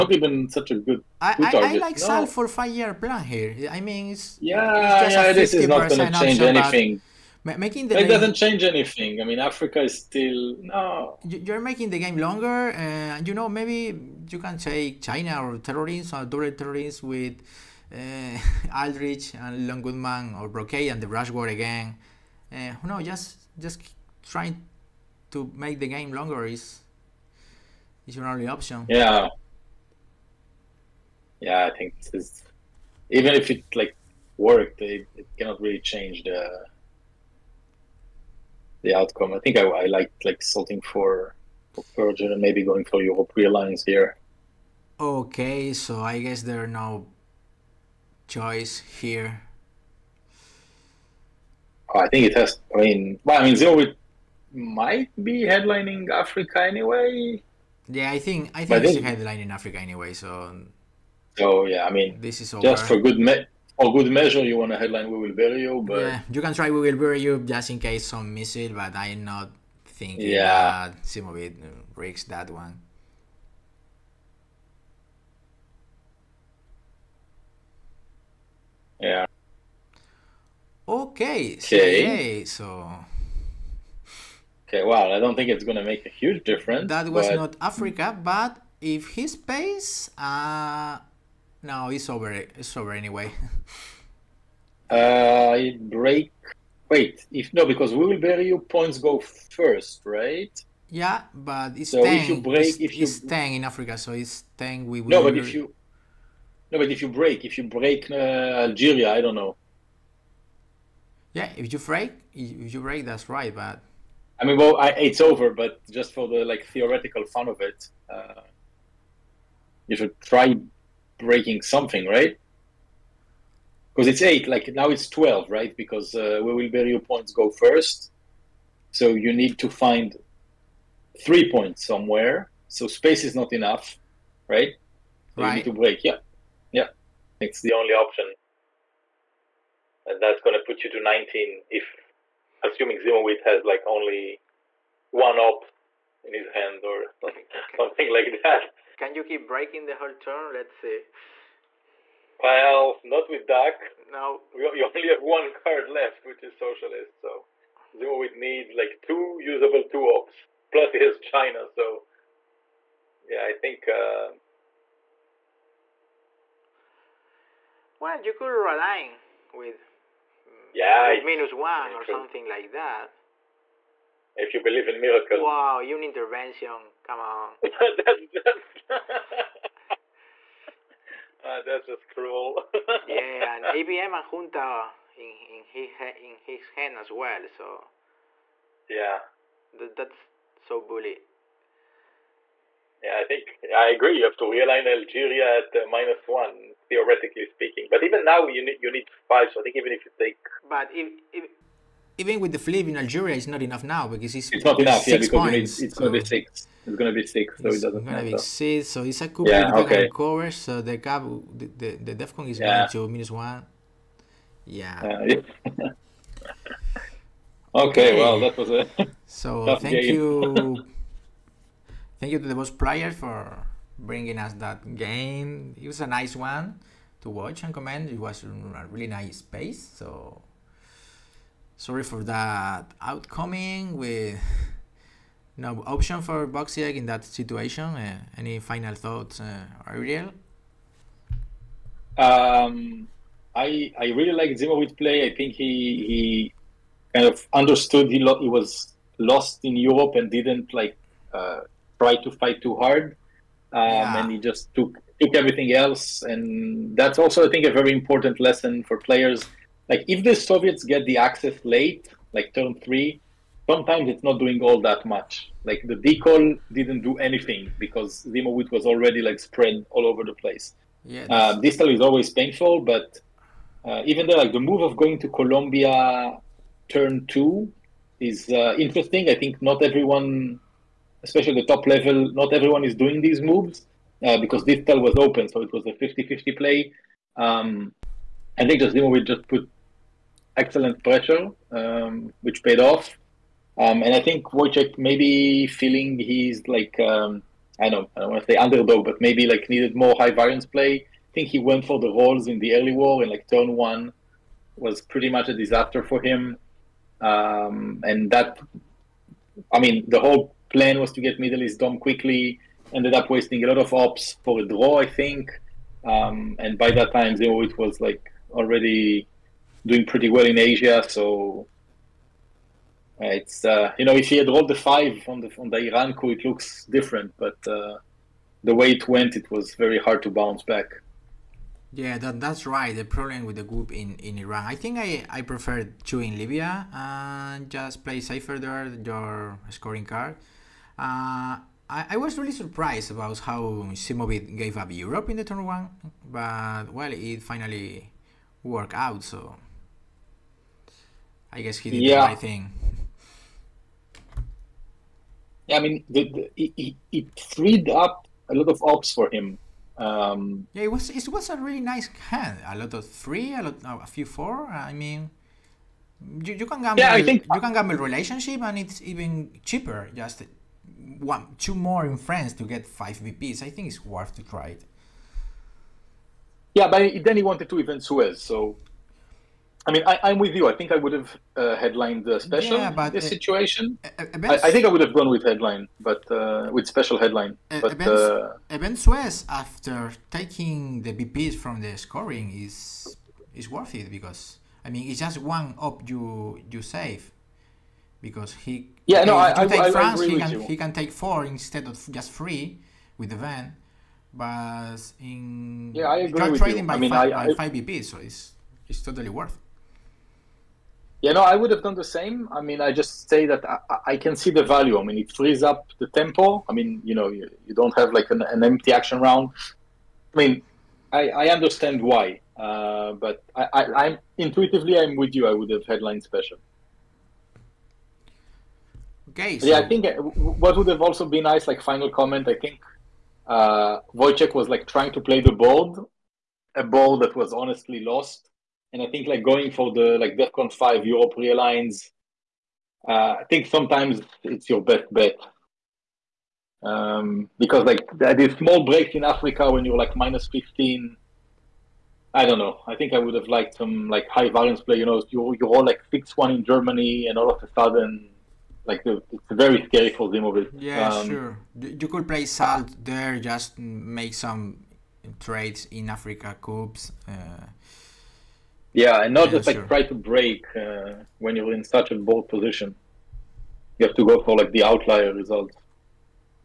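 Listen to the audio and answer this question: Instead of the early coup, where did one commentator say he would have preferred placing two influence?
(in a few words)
Libya.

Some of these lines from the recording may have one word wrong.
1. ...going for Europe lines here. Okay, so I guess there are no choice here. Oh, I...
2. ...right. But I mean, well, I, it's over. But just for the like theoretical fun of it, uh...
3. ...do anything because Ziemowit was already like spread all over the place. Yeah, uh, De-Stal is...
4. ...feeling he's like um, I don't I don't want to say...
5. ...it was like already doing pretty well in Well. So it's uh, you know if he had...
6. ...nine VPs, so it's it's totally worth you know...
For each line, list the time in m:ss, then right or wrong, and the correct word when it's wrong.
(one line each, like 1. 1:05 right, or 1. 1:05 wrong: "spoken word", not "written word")
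1. 0:42 right
2. 1:53 right
3. 4:27 right
4. 4:55 right
5. 5:17 wrong: "Asia", not "Well"
6. 6:47 wrong: "five", not "nine".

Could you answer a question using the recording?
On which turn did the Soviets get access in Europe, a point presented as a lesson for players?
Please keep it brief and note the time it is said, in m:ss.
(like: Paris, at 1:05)
turn three, at 4:22.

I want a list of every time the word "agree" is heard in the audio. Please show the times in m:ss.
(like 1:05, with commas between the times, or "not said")
3:13, 6:46.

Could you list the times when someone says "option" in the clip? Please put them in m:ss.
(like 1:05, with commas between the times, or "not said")
0:28, 2:17, 3:55.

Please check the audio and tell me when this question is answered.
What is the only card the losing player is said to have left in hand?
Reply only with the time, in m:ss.
2:36.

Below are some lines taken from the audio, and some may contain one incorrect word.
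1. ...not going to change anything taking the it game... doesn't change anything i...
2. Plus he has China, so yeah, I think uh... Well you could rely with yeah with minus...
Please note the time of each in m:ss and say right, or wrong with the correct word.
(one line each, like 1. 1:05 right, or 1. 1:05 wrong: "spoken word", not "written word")
1. 0:05 wrong: "making", not "taking"
2. 2:40 right.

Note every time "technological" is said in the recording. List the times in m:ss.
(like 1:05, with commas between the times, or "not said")
not said.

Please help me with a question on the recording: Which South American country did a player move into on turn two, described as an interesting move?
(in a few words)
Colombia.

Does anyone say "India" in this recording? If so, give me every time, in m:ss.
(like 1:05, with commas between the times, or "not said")
not said.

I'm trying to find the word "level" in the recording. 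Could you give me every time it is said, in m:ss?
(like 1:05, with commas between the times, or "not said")
4:41.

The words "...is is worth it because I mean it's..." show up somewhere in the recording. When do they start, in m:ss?
6:32.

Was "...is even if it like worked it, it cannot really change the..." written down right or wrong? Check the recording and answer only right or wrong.
right.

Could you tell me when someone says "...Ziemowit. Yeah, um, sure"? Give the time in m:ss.
7:40.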